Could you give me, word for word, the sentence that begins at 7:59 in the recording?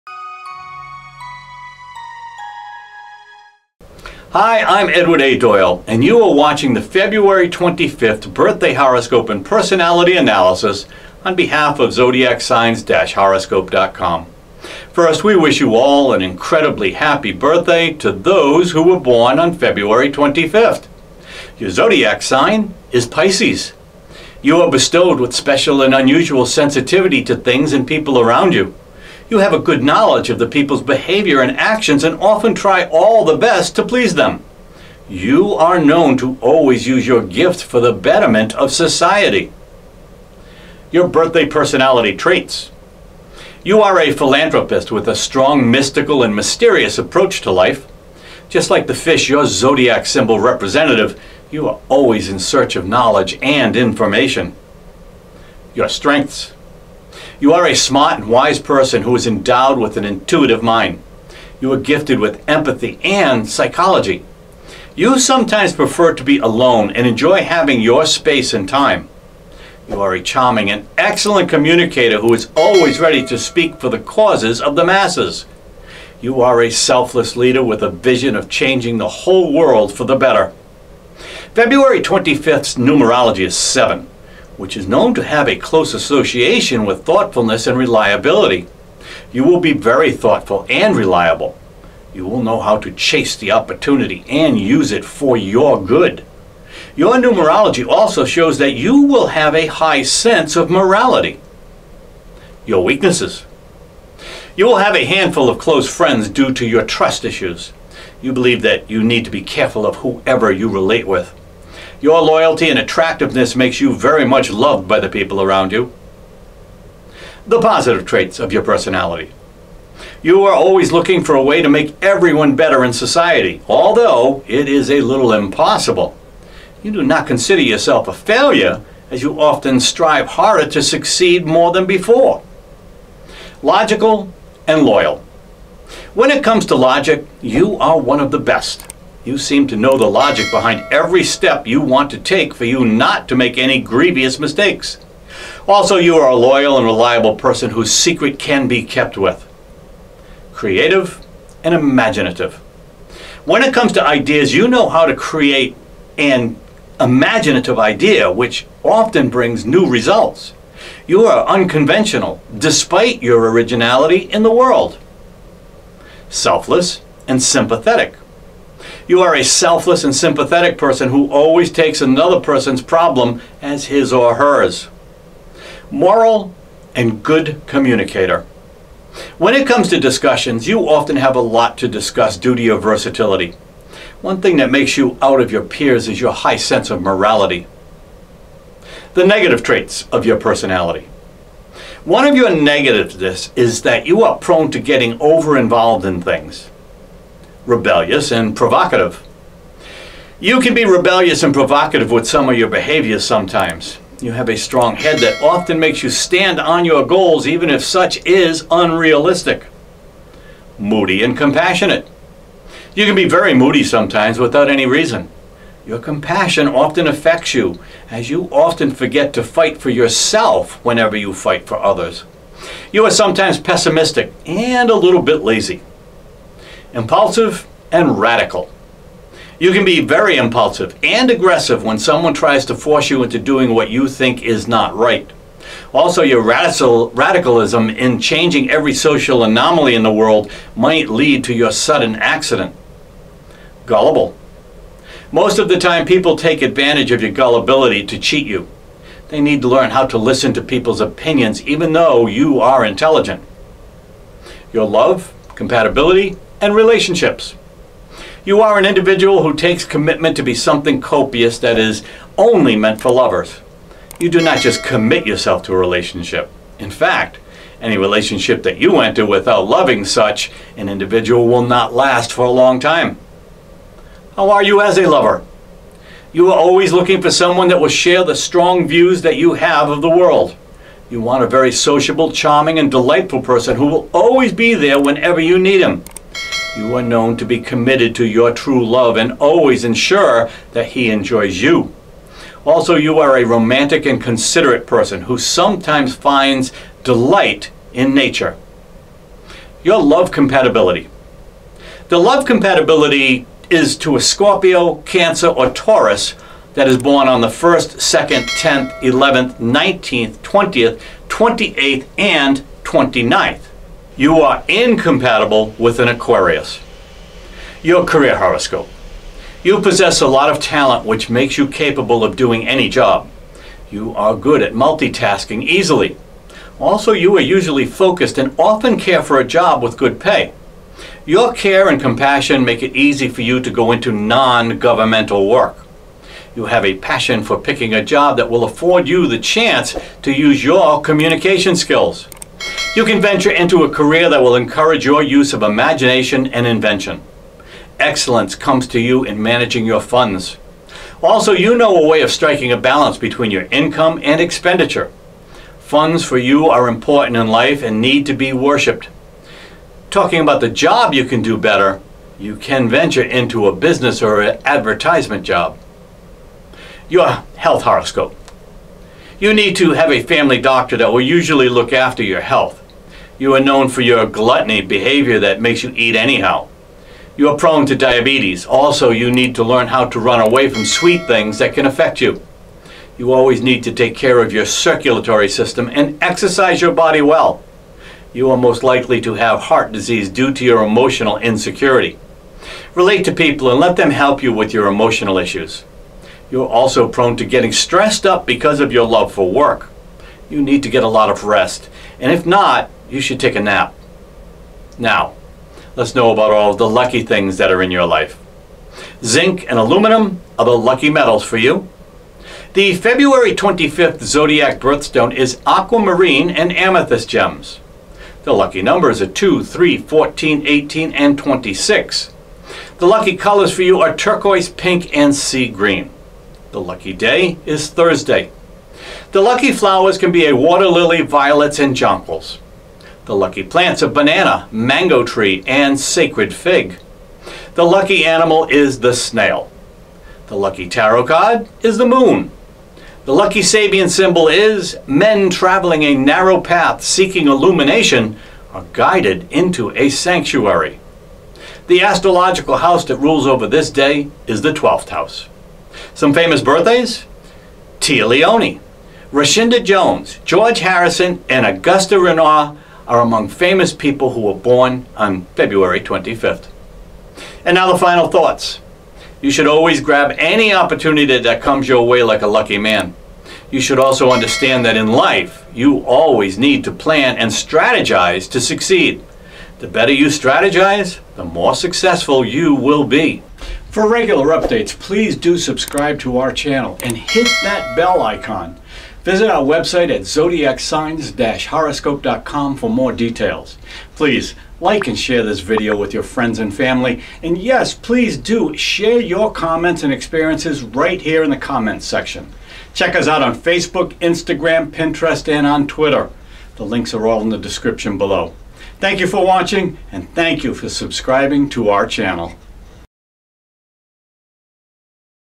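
The better you strategize, the more successful you will be.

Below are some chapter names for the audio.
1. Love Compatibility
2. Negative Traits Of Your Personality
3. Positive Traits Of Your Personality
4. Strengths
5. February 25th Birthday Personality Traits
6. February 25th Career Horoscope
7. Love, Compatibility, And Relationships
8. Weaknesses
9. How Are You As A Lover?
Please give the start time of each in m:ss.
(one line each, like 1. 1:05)
1. 4:59
2. 3:08
3. 1:57
4. 0:55
5. 0:40
6. 5:17
7. 4:14
8. 1:42
9. 4:33.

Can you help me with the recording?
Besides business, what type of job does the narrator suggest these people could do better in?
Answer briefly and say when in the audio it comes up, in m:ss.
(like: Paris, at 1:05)
advertisement, at 6:04.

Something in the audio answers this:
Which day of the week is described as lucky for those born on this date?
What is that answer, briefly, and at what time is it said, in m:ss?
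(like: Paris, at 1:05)
Thursday, at 7:07.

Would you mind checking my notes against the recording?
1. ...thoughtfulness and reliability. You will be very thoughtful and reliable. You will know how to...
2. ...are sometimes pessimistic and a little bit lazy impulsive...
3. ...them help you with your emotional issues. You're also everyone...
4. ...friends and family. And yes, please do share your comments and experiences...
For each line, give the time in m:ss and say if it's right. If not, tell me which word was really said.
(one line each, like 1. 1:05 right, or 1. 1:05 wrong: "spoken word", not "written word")
1. 1:27 right
2. 3:43 right
3. 6:33 wrong: "prone", not "everyone"
4. 8:16 right.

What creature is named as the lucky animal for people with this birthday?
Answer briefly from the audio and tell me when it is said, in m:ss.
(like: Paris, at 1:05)
Snail, at 7:19.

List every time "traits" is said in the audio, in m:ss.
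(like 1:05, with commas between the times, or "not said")
0:42, 1:58, 3:09.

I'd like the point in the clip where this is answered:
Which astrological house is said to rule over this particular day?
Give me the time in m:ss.
7:34.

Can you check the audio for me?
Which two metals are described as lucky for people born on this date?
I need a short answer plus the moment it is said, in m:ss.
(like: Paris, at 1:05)
Zinc and aluminum, at 6:49.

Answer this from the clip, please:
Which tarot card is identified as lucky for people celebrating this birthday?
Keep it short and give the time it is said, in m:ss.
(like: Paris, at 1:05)
The Moon, at 7:21.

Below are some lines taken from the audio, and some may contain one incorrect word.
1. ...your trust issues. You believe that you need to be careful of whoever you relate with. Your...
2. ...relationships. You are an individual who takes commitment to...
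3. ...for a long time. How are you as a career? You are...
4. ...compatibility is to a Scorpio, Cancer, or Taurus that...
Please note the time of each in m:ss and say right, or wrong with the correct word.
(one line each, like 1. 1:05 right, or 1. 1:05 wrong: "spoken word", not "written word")
1. 1:46 right
2. 4:16 right
3. 4:32 wrong: "lover", not "career"
4. 5:02 right.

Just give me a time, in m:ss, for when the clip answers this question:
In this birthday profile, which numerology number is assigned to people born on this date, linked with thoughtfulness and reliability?
1:23.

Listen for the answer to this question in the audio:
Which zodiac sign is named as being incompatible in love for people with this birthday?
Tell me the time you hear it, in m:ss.
5:16.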